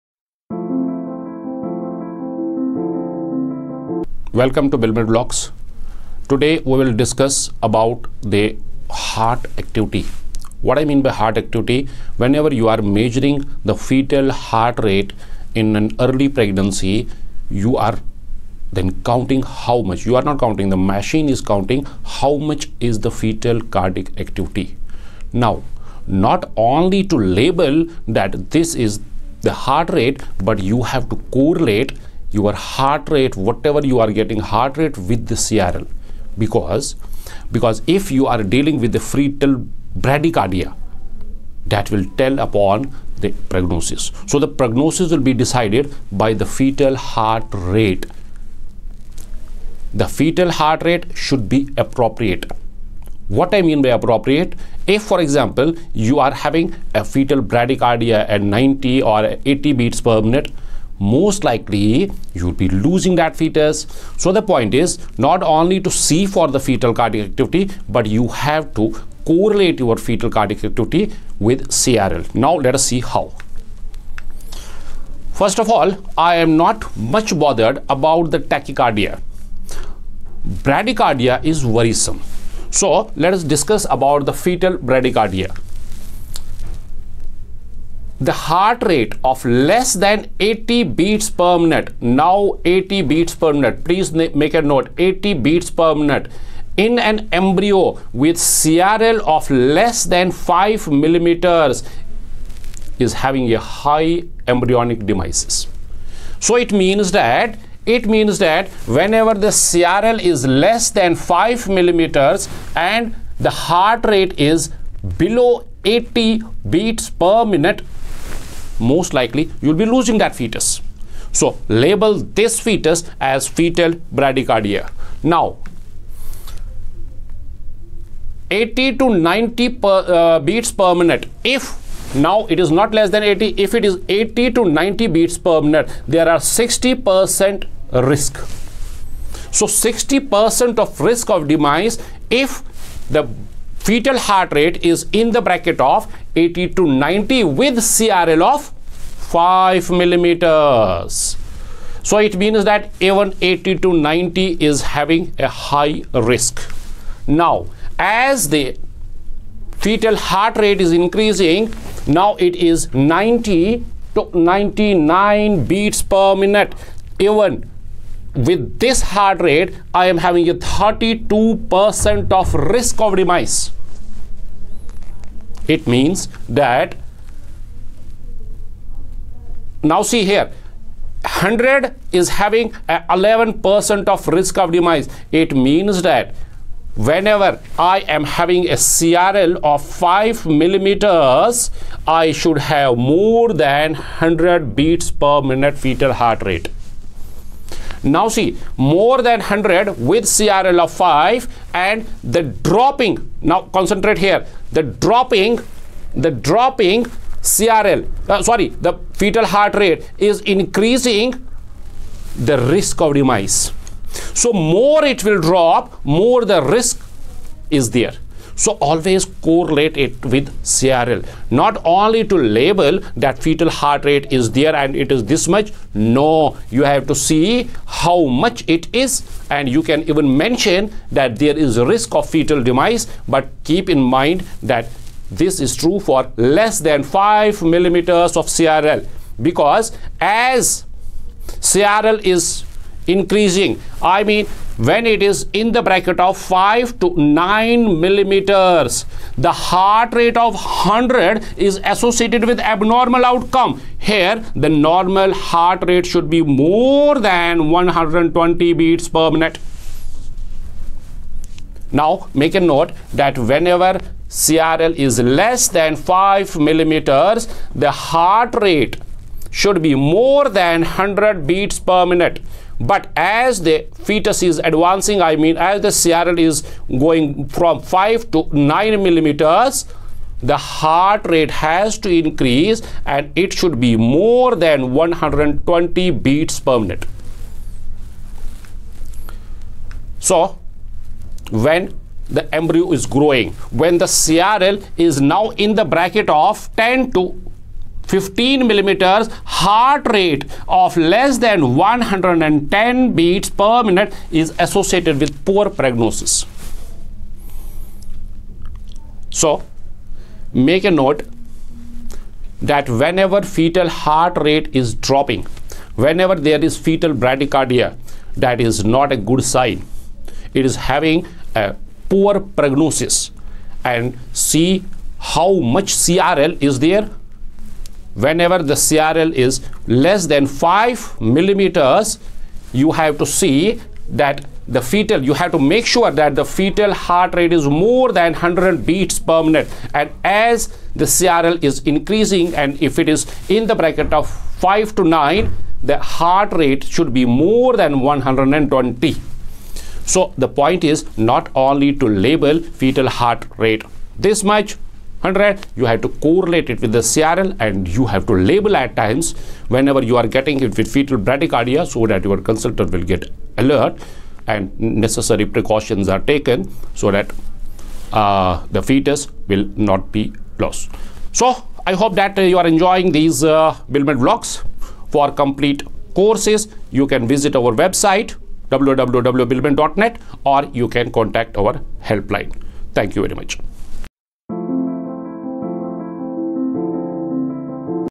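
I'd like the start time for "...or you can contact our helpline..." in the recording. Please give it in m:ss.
6:20.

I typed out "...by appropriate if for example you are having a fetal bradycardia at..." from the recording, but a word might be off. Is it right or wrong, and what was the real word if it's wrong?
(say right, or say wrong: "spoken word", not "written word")
right.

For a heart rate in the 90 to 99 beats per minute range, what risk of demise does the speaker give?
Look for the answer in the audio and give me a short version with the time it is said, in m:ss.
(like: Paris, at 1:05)
32%, at 2:50.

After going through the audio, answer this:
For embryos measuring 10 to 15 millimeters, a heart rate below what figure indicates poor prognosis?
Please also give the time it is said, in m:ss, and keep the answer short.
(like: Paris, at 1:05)
110 beats per minute, at 5:01.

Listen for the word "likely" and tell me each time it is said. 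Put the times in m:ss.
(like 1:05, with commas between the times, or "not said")
1:01, 1:59.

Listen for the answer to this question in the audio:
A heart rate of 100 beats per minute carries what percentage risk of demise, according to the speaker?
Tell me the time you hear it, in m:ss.
3:02.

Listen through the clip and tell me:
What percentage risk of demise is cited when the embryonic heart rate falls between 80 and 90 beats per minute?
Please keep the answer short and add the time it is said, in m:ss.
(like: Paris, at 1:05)
60%, at 2:19.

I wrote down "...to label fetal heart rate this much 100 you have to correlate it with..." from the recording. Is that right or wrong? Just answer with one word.
right.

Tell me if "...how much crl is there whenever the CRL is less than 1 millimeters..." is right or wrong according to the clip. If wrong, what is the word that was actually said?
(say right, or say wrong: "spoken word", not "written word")
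wrong: "5", not "1".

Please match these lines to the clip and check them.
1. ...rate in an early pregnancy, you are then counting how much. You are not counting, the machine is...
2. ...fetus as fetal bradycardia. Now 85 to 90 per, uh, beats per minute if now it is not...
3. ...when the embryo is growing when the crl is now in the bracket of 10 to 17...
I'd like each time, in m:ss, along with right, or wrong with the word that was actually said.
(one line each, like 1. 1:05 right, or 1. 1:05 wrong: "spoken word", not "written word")
1. 0:14 right
2. 2:02 wrong: "80", not "85"
3. 4:51 wrong: "15", not "17".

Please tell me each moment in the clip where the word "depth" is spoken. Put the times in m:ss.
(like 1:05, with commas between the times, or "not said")
not said.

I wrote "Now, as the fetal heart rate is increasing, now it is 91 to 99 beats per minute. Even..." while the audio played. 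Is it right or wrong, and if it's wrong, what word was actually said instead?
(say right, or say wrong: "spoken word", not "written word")
wrong: "90", not "91".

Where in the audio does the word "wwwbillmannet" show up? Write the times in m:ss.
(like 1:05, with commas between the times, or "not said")
6:18.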